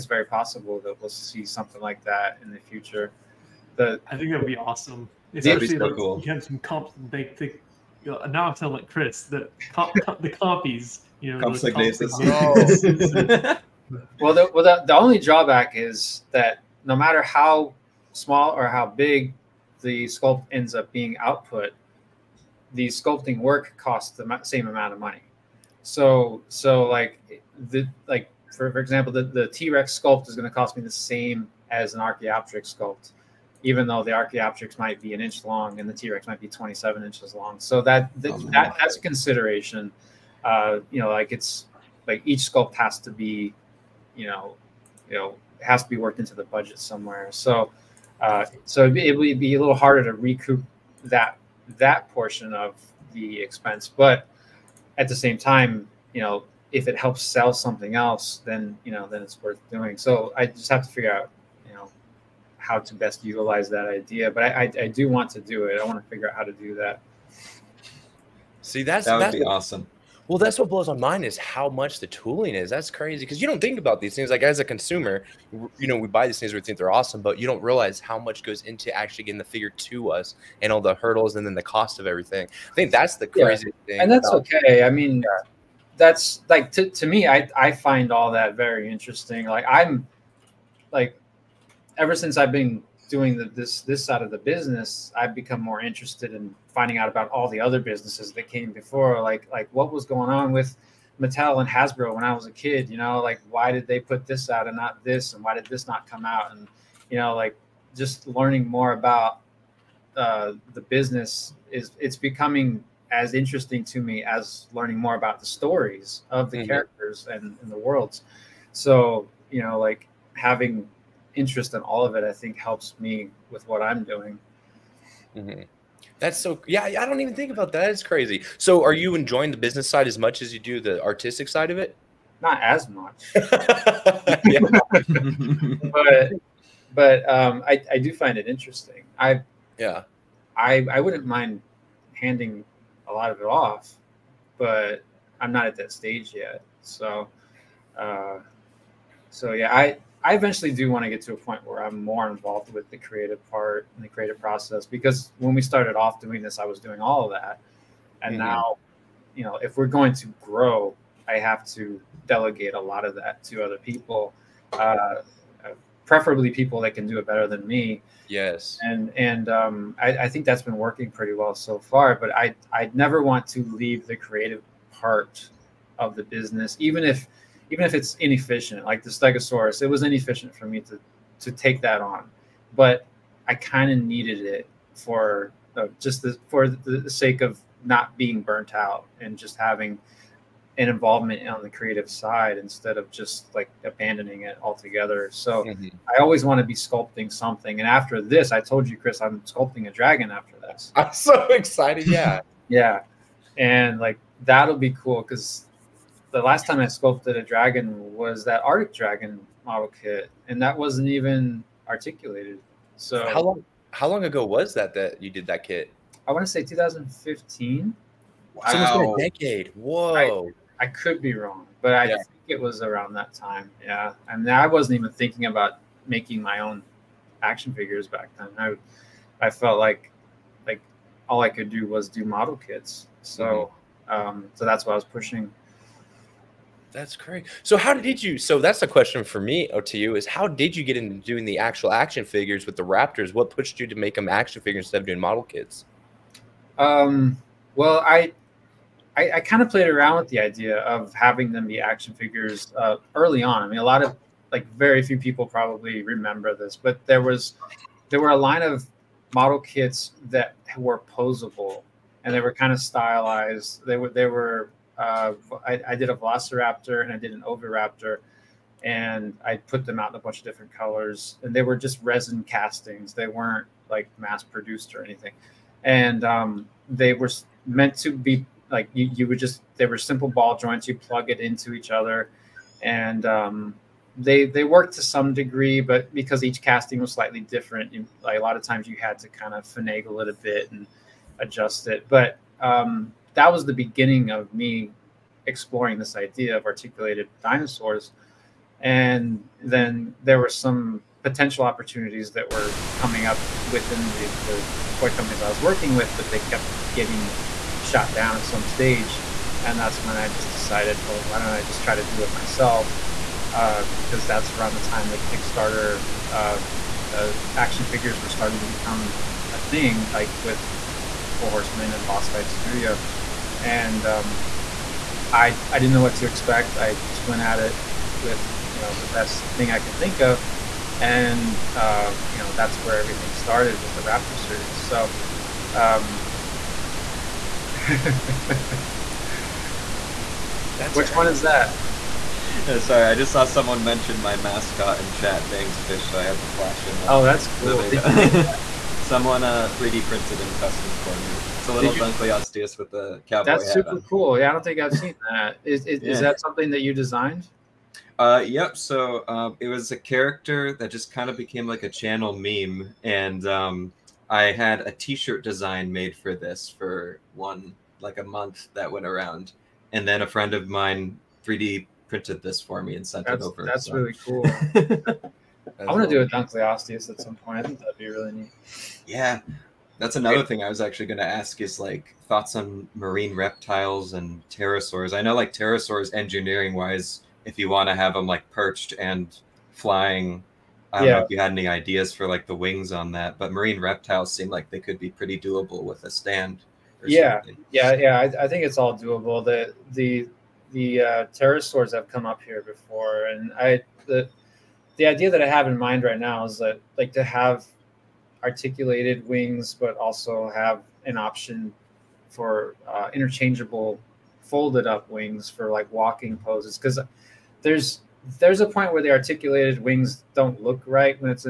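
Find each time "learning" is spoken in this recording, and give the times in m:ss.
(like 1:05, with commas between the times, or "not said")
1:48, 1:54.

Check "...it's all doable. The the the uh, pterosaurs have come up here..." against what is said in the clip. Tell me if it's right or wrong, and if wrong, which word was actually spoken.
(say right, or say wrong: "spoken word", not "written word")
right.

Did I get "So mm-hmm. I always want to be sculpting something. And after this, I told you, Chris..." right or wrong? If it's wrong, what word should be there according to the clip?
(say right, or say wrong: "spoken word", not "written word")
right.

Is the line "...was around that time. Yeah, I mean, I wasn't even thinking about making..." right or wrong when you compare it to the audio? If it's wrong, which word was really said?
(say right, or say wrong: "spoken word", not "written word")
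right.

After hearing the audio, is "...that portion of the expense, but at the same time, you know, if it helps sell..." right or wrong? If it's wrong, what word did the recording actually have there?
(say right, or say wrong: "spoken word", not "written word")
right.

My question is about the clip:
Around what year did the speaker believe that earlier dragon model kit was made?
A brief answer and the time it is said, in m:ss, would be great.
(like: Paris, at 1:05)
2015, at 3:36.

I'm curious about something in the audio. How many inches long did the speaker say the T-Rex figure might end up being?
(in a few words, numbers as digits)
27.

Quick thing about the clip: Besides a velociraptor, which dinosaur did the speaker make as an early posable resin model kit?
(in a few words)
Oviraptor.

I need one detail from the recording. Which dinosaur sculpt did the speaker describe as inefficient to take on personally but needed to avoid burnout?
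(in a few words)
Stegosaurus.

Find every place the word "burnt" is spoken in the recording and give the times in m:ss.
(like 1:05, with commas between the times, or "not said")
3:08.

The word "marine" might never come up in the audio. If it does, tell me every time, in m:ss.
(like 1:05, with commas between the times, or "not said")
6:22, 6:33.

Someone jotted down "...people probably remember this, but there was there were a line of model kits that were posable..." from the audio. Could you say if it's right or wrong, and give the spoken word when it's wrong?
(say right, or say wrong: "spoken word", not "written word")
right.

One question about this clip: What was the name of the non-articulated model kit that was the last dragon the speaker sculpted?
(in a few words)
Arctic Dragon.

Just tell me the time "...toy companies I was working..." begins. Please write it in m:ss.
5:04.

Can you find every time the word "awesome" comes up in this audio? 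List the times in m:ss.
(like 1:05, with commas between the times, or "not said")
0:04, 1:09, 1:16.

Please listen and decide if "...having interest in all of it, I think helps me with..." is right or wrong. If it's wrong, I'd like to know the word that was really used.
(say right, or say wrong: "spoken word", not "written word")
right.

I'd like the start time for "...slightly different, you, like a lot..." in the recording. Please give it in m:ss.
4:47.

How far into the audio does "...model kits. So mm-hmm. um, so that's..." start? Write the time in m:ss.
3:52.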